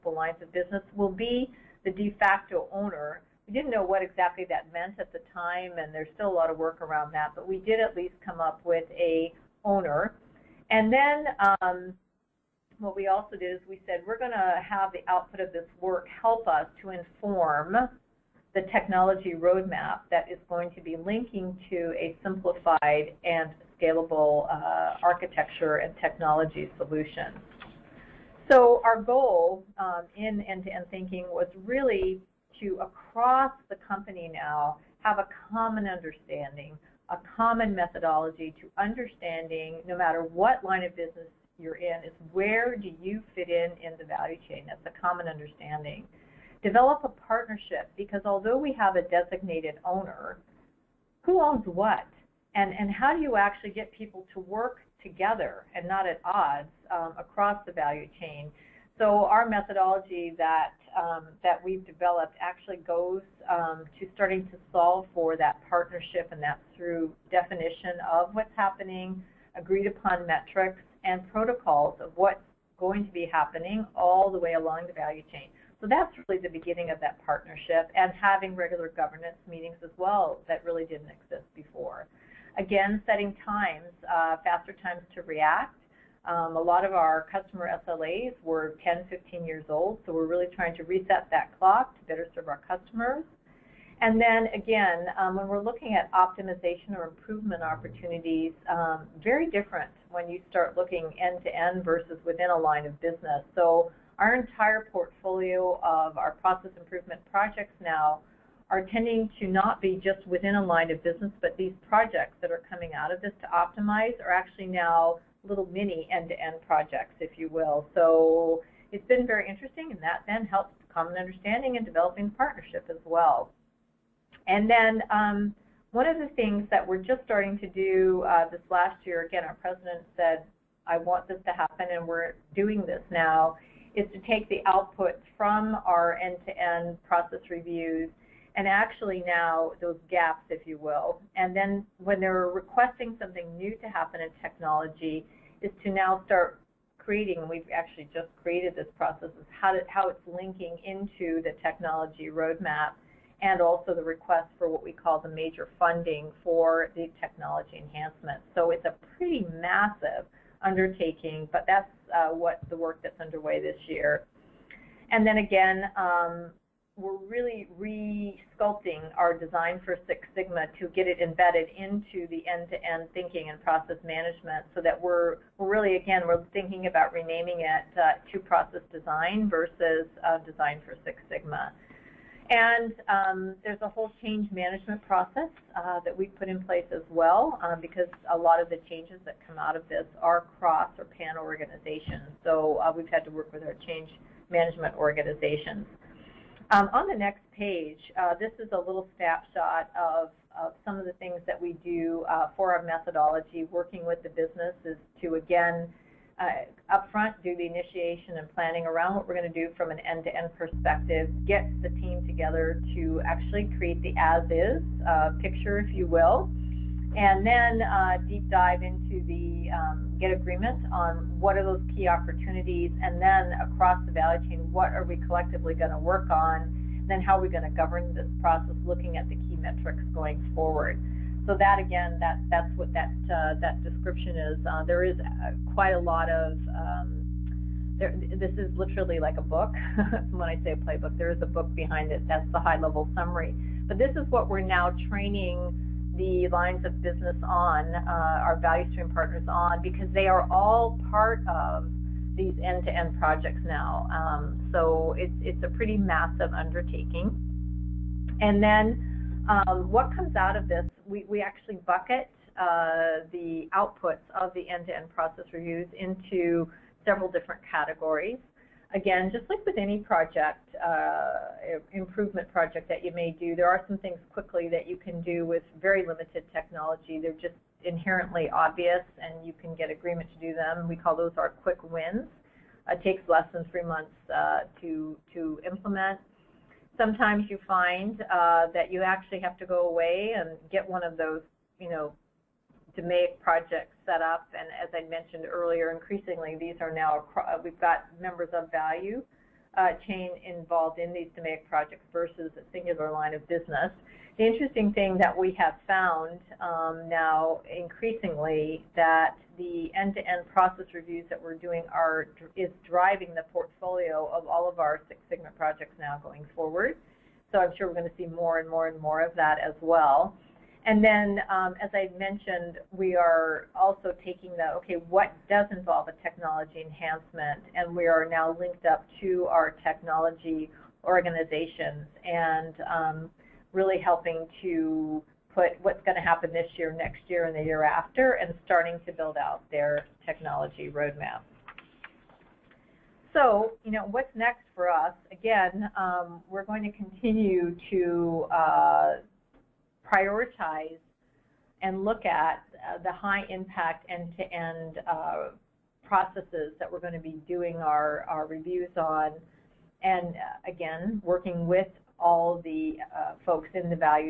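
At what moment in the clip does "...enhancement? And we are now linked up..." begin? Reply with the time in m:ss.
5:26.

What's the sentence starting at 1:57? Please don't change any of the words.
So it's been very interesting, and that then helps common understanding and developing partnership as well.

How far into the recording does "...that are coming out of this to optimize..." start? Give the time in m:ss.
1:52.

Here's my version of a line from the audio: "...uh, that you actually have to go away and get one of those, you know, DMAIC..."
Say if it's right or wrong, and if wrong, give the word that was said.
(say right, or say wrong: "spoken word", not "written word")
right.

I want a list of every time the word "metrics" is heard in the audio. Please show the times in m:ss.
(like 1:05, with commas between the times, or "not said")
1:10, 3:49.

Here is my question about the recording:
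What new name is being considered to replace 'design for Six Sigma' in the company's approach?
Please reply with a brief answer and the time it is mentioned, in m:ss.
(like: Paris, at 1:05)
Process design, at 2:58.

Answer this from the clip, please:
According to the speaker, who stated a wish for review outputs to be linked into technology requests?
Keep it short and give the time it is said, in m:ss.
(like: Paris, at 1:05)
Our president, at 2:09.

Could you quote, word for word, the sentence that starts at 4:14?
Um, so it's it's a pretty massive undertaking.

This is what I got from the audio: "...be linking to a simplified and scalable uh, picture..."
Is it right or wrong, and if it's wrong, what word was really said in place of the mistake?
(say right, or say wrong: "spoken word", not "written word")
wrong: "architecture", not "picture".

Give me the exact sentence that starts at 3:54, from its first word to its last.
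Uh, there is uh, quite a lot of um, there, this is literally like a book.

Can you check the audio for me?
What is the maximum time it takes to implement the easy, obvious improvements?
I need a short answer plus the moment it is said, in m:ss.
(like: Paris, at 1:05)
Three months, at 4:43.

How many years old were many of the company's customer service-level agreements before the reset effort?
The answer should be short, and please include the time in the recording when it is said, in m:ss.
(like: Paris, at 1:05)
10 to 15 years, at 1:28.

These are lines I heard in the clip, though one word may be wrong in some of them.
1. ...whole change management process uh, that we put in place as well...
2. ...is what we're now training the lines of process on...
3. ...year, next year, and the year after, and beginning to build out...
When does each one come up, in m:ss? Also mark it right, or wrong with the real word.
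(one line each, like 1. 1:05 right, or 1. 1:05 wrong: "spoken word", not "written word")
1. 3:03 right
2. 4:04 wrong: "business", not "process"
3. 5:36 wrong: "starting", not "beginning".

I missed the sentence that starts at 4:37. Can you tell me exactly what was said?
They're just inherently obvious and you can get agreement to do them.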